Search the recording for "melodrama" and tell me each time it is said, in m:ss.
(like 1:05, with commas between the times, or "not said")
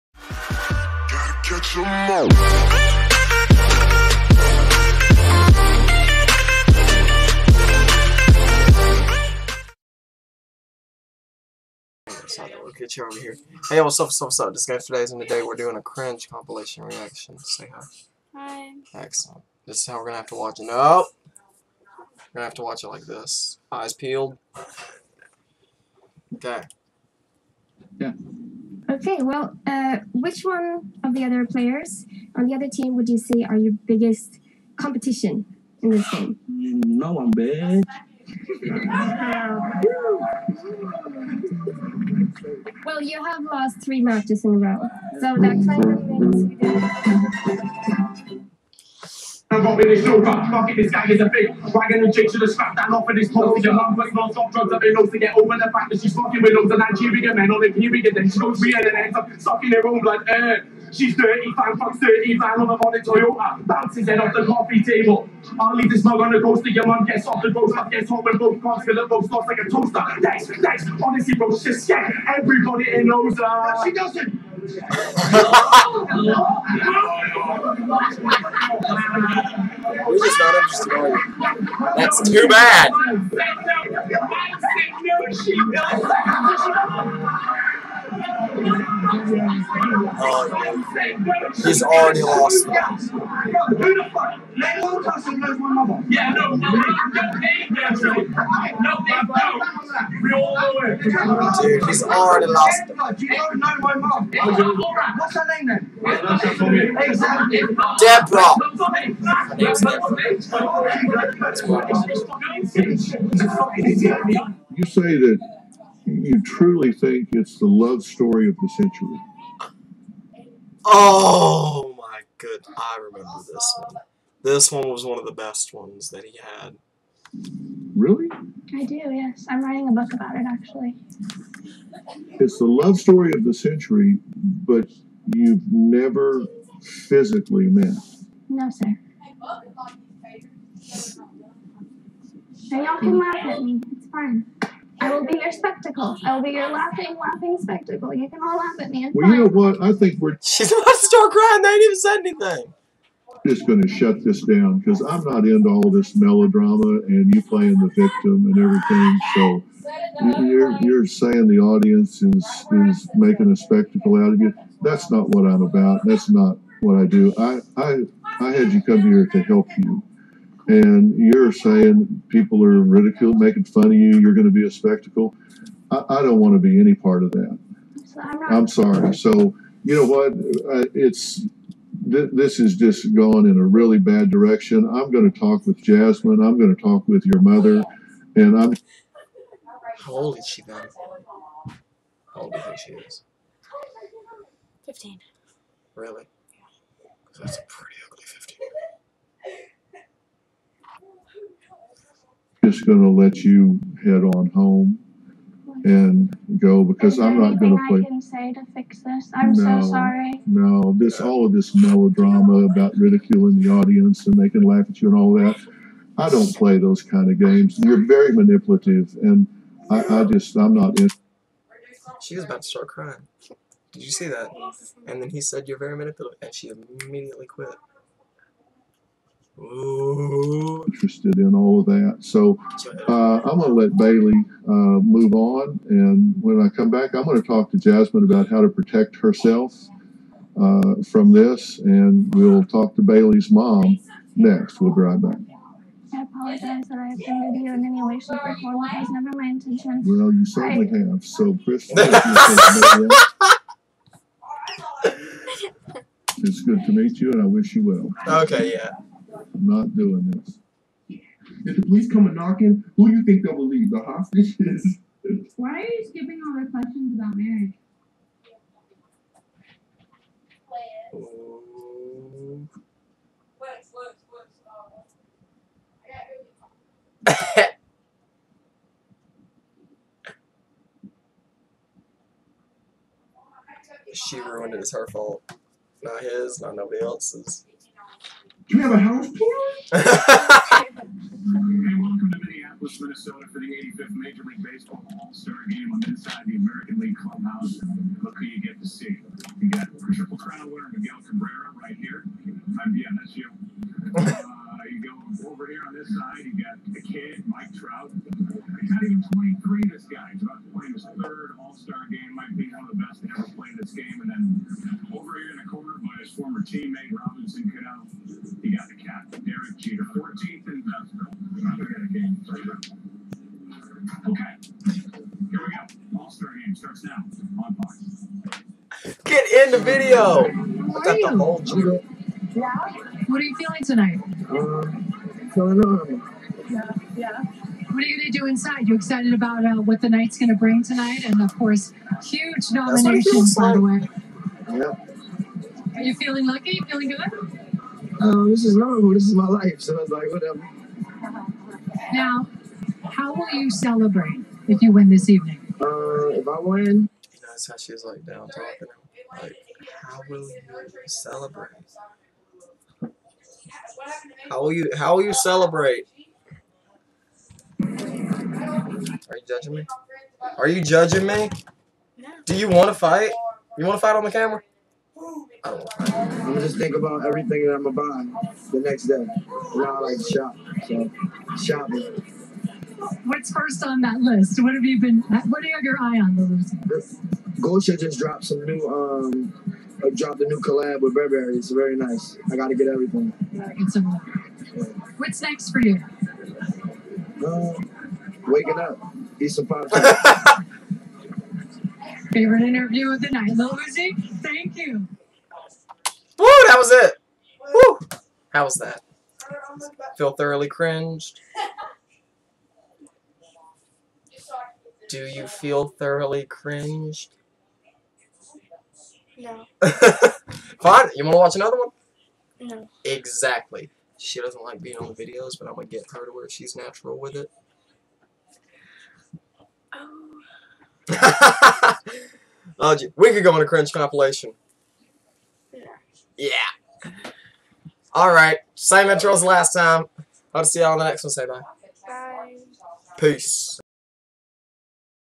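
2:36, 3:31.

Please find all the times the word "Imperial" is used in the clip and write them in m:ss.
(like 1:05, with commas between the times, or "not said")
0:57.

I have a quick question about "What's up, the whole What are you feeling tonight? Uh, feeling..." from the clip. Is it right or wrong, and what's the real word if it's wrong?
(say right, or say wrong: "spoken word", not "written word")
right.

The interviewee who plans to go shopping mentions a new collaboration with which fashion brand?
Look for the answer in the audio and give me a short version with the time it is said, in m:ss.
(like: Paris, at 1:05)
Burberry, at 6:31.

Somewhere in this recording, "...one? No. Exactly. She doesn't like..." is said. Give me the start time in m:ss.
7:01.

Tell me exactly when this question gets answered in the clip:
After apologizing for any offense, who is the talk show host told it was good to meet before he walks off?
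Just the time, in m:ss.
4:11.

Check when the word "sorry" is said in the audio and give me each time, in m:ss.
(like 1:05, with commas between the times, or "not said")
2:58, 3:29.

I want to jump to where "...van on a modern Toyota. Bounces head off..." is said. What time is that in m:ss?
1:02.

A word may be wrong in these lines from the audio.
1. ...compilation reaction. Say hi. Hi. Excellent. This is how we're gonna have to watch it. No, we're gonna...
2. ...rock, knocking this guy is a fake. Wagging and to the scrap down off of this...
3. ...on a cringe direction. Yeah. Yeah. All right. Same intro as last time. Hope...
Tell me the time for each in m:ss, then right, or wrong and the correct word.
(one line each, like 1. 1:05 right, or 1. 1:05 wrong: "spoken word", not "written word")
1. 0:16 right
2. 0:50 right
3. 7:13 wrong: "compilation", not "direction".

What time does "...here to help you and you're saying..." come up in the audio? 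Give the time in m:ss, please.
2:49.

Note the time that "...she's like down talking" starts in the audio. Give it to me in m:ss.
5:57.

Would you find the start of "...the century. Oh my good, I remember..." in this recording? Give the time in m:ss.
1:58.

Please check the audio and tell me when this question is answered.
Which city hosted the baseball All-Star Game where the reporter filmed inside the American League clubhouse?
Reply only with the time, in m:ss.
4:52.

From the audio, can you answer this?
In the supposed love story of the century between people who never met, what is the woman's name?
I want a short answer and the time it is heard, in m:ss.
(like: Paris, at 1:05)
Deborah, at 1:47.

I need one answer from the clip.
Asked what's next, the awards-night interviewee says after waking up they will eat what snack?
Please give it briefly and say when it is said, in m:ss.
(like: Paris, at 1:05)
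Popcorn, at 6:39.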